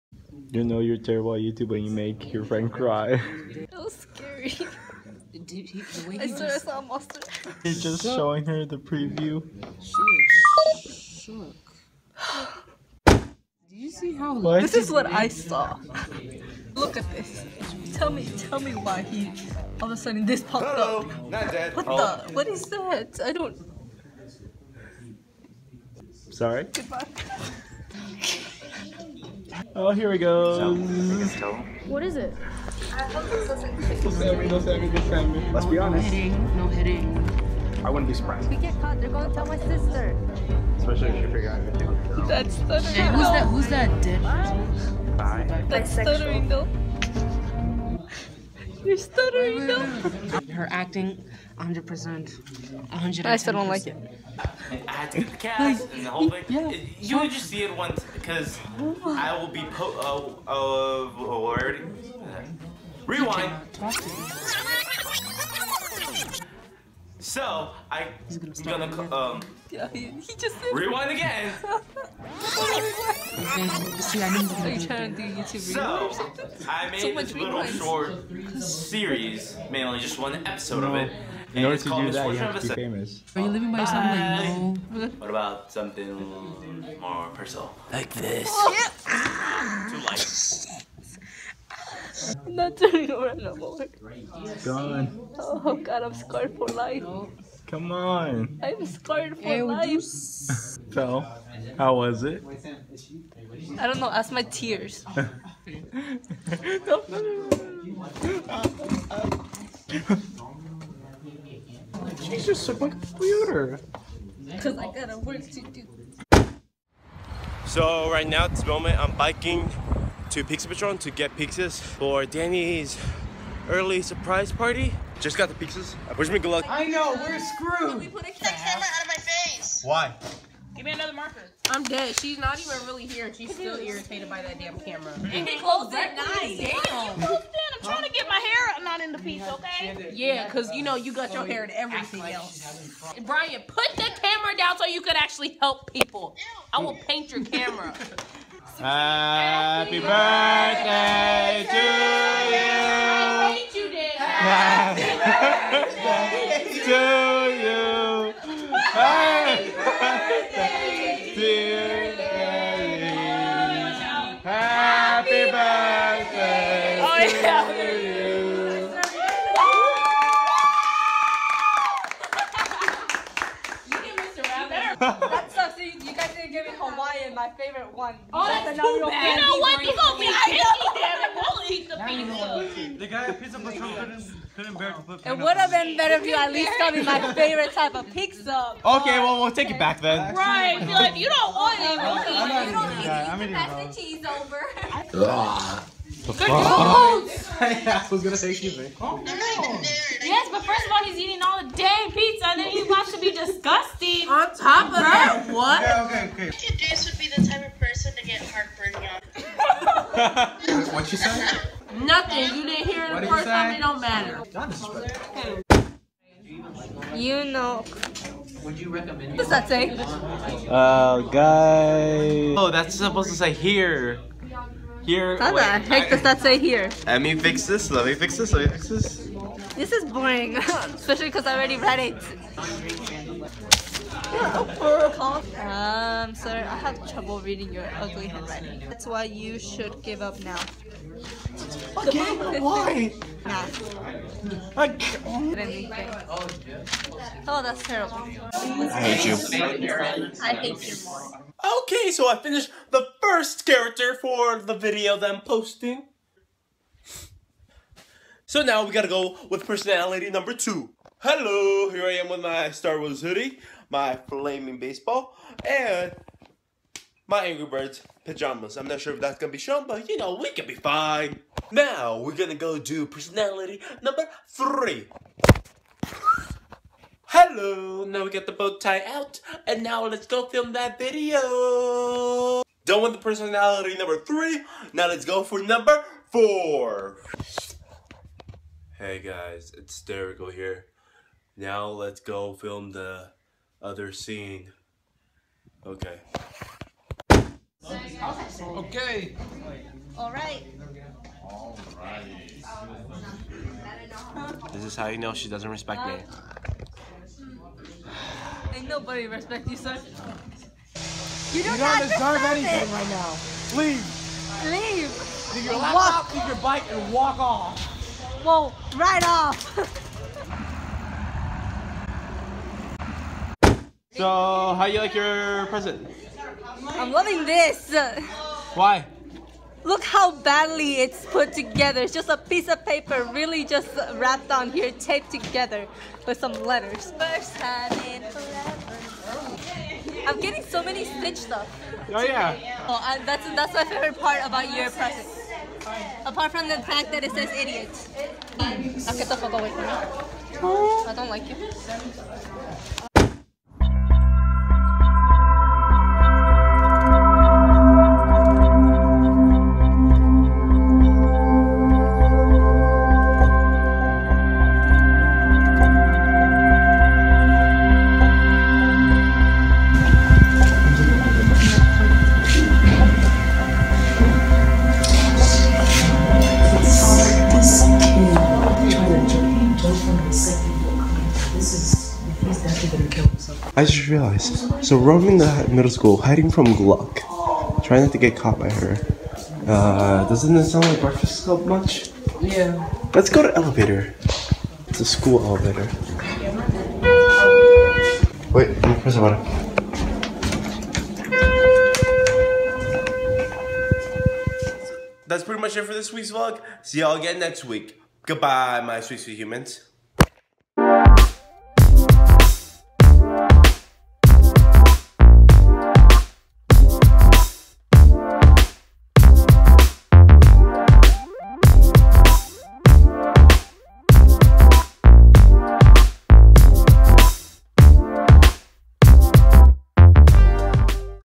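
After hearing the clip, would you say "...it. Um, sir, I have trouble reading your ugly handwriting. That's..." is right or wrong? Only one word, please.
right.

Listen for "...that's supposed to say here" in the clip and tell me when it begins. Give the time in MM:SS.
03:42.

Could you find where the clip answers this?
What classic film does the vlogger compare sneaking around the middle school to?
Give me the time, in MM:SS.
06:30.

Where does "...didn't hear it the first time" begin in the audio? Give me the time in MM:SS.
03:32.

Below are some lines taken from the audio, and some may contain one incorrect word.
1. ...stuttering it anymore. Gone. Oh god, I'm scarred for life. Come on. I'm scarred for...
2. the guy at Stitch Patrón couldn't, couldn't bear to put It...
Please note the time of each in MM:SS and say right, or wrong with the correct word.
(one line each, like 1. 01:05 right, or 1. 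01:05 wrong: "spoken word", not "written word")
1. 01:32 wrong: "turning", not "stuttering"
2. 03:02 wrong: "Pizza", not "Stitch".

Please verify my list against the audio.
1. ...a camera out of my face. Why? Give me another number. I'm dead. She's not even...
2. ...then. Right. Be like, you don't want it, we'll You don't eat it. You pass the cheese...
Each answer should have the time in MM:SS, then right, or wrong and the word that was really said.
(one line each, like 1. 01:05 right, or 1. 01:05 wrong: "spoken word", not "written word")
1. 02:08 wrong: "marker", not "number"
2. 03:10 right.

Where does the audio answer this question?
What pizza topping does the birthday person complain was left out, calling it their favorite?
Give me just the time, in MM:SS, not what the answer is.
02:56.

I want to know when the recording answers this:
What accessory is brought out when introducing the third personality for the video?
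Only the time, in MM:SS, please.
04:38.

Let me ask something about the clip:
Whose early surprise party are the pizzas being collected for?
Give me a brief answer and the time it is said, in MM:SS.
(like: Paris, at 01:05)
Danny, at 02:02.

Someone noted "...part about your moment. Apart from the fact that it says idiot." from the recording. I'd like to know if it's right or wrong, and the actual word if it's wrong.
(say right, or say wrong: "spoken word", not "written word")
wrong: "present", not "moment".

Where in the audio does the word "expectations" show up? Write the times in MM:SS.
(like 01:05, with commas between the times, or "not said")
not said.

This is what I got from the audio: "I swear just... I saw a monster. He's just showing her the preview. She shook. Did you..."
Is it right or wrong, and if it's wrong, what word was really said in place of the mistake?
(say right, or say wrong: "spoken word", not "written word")
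right.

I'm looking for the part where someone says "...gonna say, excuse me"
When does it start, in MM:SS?
03:18.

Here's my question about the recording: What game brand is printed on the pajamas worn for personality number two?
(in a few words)
Angry Birds.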